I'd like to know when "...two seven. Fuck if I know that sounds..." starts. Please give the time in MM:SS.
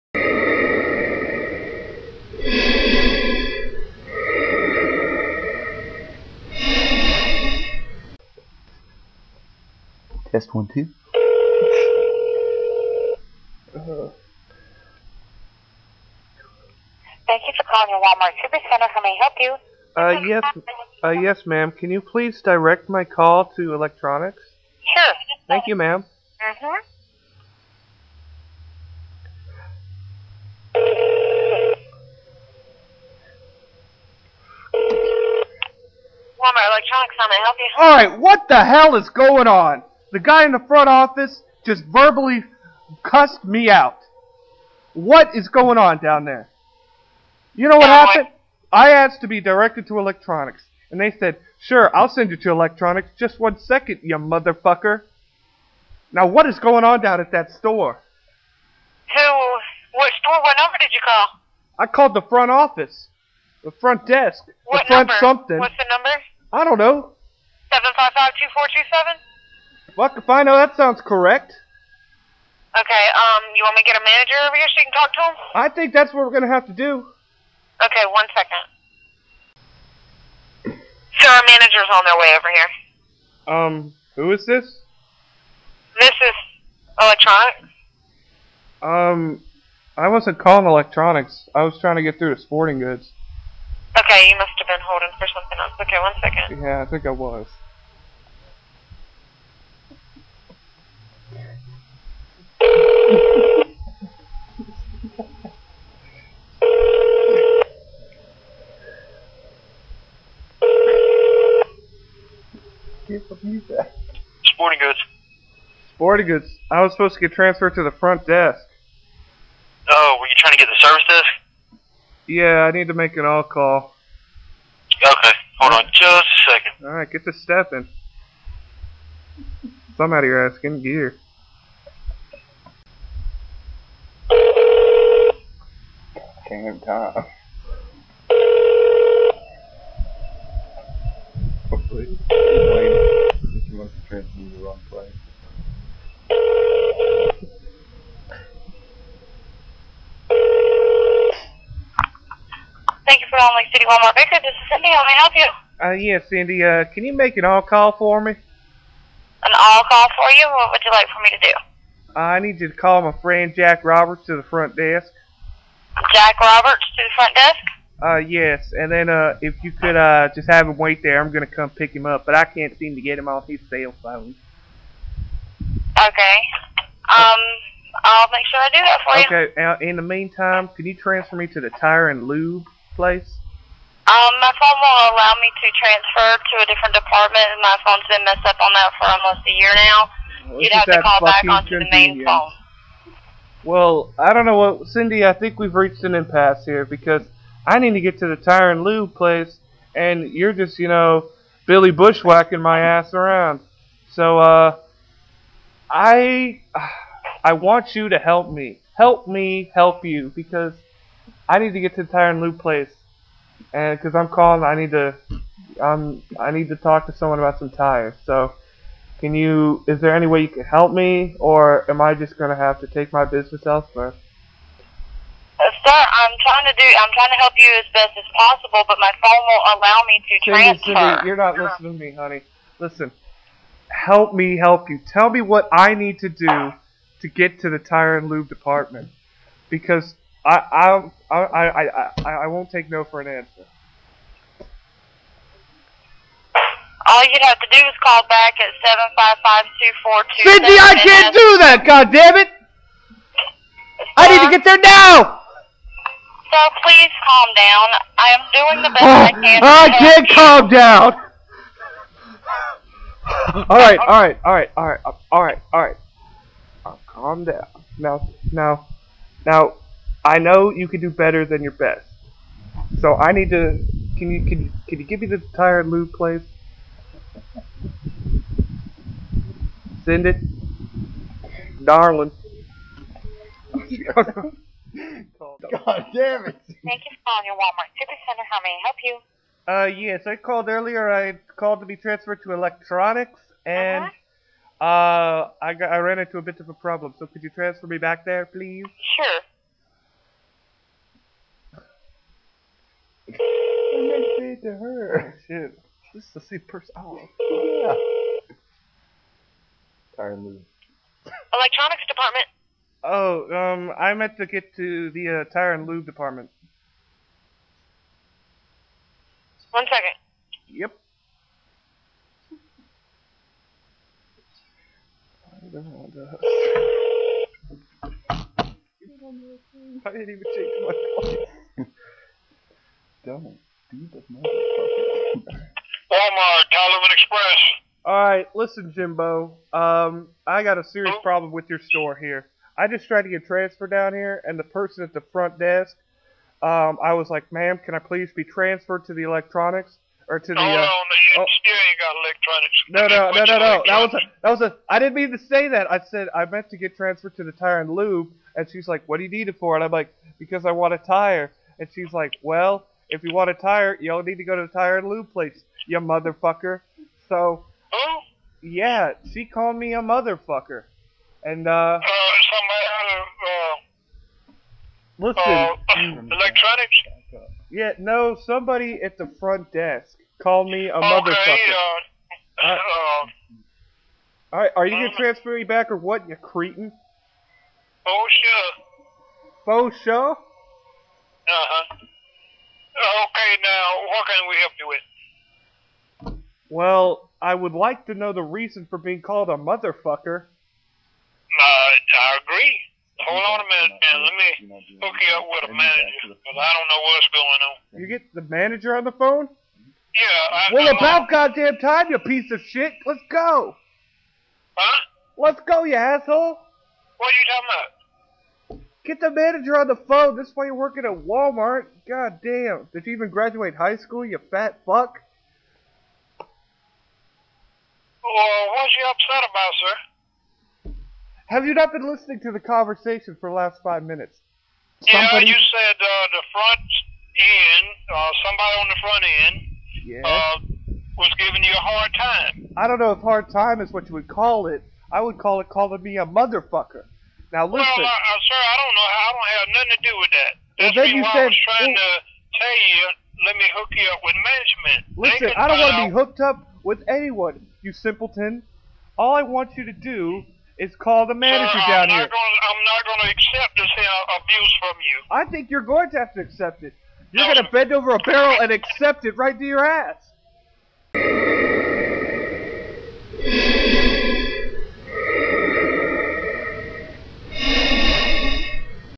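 01:08.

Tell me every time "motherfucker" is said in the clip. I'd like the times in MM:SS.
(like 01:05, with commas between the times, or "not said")
00:54, 06:05, 06:10, 06:21, 06:39, 07:26.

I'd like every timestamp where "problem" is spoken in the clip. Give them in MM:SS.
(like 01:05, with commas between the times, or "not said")
04:56, 05:41.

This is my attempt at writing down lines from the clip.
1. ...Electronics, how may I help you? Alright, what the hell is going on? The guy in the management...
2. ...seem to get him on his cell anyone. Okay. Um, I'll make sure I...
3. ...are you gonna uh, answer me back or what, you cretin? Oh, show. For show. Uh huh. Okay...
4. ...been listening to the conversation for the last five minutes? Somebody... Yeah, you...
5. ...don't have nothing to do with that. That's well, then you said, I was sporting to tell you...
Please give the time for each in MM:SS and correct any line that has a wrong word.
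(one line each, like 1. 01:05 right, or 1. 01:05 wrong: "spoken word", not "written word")
1. 00:36 wrong: "front", not "management"
2. 02:52 wrong: "phone", not "anyone"
3. 06:24 wrong: "transfer", not "answer"
4. 07:11 right
5. 07:29 wrong: "trying", not "sporting".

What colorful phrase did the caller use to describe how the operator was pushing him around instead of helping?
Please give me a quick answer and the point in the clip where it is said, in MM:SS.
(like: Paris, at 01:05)
Billy Bushwhacking, at 03:21.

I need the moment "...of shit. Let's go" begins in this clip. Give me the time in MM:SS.
06:52.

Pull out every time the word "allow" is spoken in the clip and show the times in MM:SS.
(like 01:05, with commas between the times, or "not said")
03:05, 03:49.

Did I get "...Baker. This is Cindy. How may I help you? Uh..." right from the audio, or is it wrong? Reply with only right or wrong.
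right.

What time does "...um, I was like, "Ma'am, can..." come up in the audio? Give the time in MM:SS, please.
05:46.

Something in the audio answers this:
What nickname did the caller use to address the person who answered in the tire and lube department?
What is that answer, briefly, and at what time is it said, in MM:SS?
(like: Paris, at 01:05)
Jimbo, at 05:38.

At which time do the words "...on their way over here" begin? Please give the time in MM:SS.
01:21.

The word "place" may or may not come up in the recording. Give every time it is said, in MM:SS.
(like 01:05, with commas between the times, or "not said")
03:02, 03:19, 03:32, 06:05.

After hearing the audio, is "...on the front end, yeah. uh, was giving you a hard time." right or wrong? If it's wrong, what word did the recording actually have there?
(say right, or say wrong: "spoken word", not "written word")
right.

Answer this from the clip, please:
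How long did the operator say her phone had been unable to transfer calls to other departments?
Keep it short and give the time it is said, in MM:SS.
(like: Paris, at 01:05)
almost a year, at 03:09.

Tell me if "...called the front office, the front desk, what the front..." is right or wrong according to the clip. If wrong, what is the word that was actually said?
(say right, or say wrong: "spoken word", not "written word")
right.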